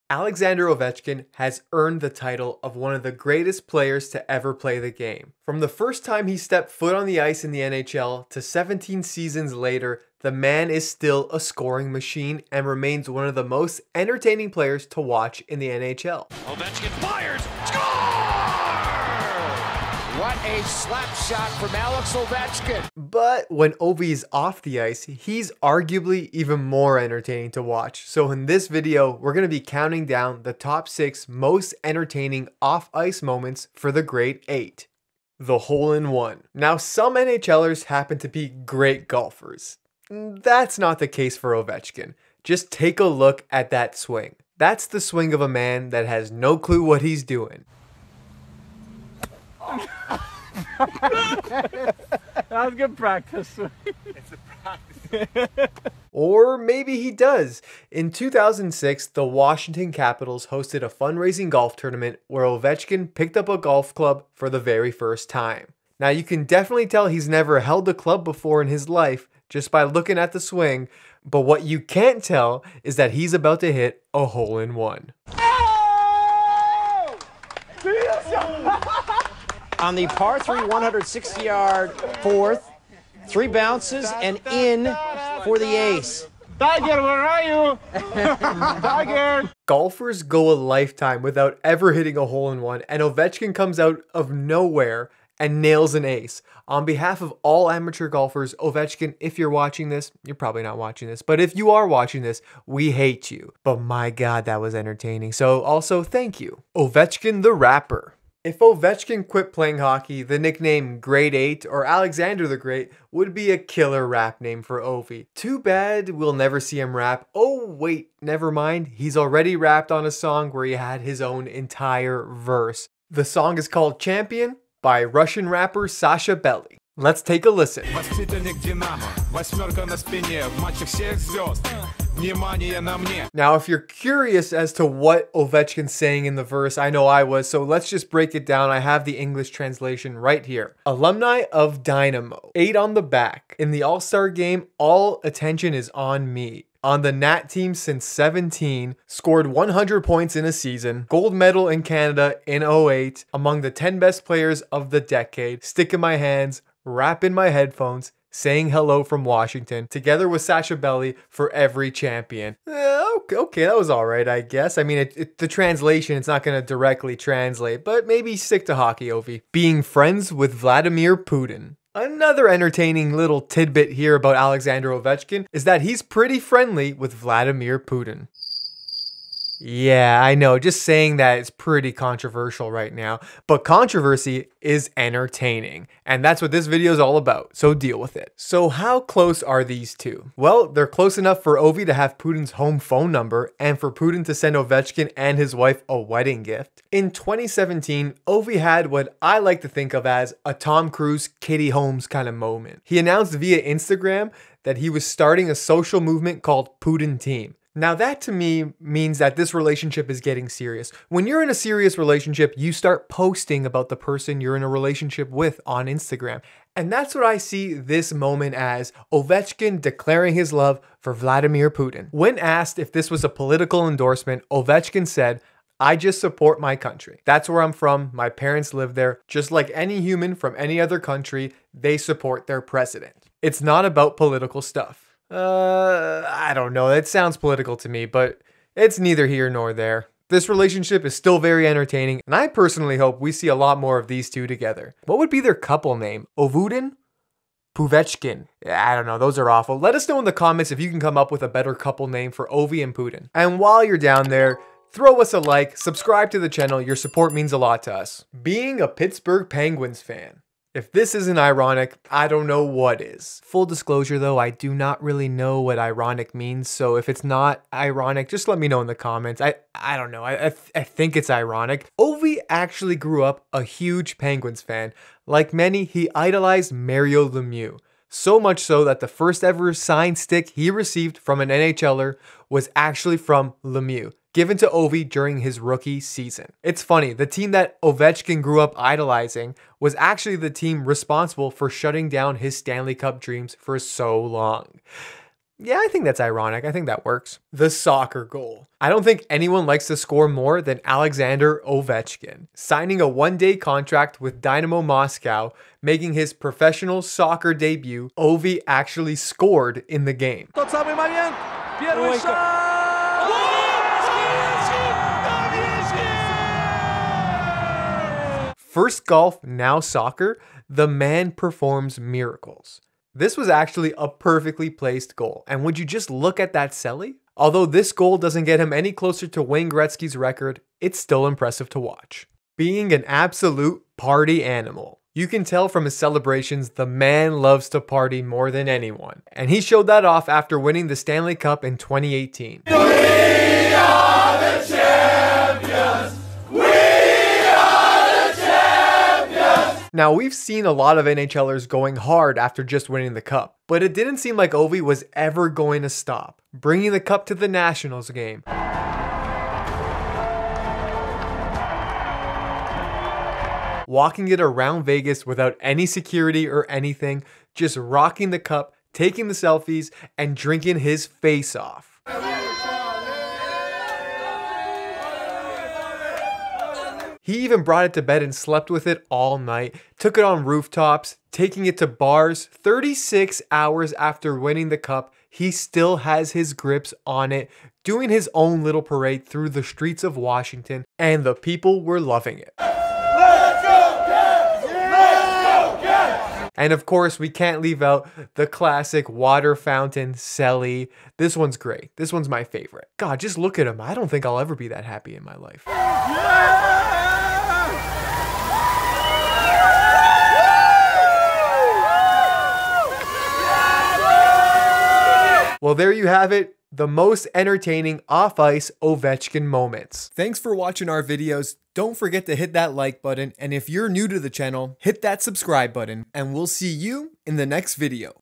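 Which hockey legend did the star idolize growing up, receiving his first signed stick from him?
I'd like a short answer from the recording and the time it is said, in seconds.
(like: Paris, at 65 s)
Mario Lemieux, at 276 s.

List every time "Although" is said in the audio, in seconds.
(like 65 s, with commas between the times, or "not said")
327 s.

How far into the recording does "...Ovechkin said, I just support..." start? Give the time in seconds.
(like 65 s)
224 s.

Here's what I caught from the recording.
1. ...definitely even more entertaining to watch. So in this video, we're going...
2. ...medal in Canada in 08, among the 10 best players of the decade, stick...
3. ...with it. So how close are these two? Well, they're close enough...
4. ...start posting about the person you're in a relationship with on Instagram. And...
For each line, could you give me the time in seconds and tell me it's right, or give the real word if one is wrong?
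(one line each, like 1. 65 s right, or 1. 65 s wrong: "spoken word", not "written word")
1. 25 s wrong: "arguably", not "definitely"
2. 151 s right
3. 187 s right
4. 212 s right.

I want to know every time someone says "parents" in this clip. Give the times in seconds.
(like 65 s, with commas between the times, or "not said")
228 s.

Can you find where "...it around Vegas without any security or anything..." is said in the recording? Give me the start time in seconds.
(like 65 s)
364 s.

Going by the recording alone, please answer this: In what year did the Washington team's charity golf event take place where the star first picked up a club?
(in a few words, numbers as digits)
2006.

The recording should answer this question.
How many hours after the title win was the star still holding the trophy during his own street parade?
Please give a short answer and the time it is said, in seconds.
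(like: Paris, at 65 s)
36, at 382 s.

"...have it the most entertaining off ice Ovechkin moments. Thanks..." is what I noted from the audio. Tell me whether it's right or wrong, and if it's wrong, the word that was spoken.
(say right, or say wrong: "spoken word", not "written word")
right.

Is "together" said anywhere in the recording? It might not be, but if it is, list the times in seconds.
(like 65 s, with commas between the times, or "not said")
159 s, 244 s.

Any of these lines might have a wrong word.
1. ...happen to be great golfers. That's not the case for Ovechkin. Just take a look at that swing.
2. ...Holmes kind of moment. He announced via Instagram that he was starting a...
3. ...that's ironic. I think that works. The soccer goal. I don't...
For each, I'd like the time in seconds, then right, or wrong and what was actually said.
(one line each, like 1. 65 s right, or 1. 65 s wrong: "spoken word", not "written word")
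1. 37 s right
2. 201 s right
3. 296 s right.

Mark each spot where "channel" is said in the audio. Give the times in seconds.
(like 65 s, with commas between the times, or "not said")
256 s, 424 s.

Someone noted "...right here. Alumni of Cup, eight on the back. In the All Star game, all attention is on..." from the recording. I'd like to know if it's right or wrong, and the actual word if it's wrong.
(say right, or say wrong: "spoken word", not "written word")
wrong: "Dynamo", not "Cup".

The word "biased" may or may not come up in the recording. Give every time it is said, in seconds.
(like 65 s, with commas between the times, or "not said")
not said.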